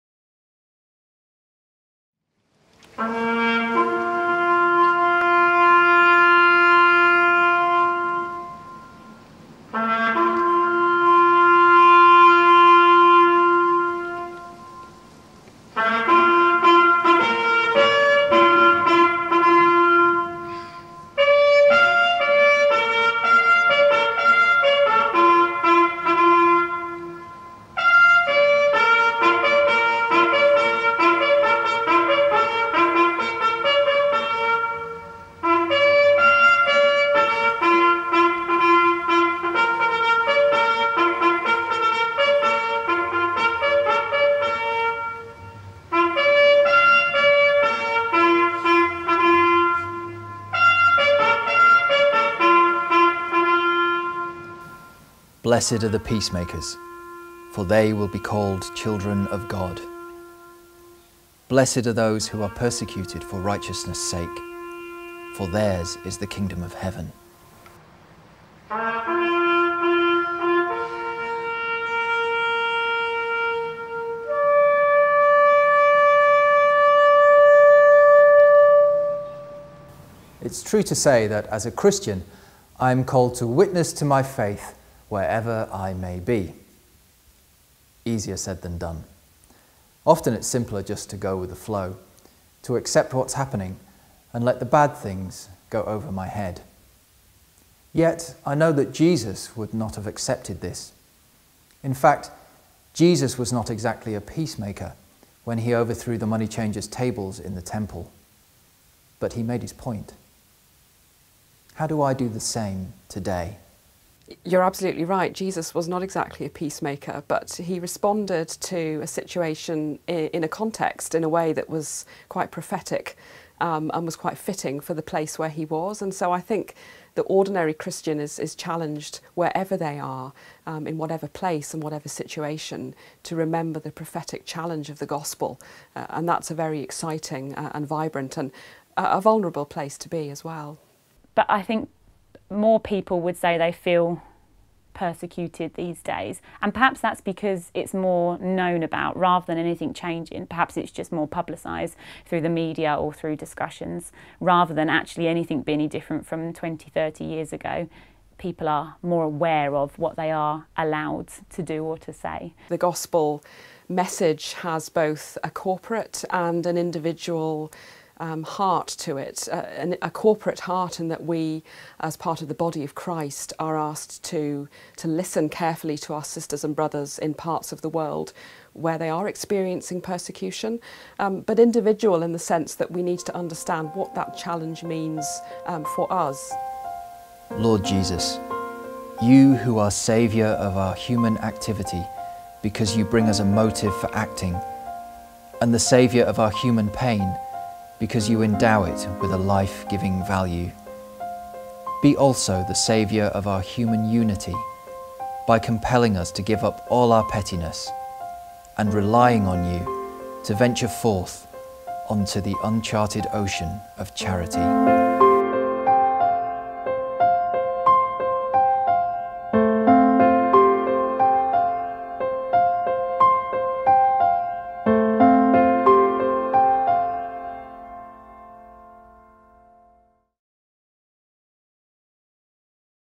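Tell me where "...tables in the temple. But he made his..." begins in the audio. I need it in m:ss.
1:46.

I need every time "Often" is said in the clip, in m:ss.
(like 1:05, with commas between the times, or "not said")
1:30.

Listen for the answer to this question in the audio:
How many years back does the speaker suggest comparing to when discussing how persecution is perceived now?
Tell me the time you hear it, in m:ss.
2:36.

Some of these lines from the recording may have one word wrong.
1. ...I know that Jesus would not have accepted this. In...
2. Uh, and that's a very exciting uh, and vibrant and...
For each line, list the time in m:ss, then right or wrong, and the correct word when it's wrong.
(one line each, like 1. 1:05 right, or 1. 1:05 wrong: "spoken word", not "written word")
1. 1:38 right
2. 2:15 right.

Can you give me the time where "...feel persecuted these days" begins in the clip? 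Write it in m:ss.
2:23.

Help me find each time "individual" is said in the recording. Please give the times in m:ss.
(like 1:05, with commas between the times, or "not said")
2:46, 3:01.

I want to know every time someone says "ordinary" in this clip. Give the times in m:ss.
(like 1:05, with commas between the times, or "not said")
2:07.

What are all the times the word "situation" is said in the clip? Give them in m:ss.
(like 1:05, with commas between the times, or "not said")
1:59, 2:12.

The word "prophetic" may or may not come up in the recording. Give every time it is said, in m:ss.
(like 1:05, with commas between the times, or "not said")
2:02, 2:13.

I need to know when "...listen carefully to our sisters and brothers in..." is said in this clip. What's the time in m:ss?
2:55.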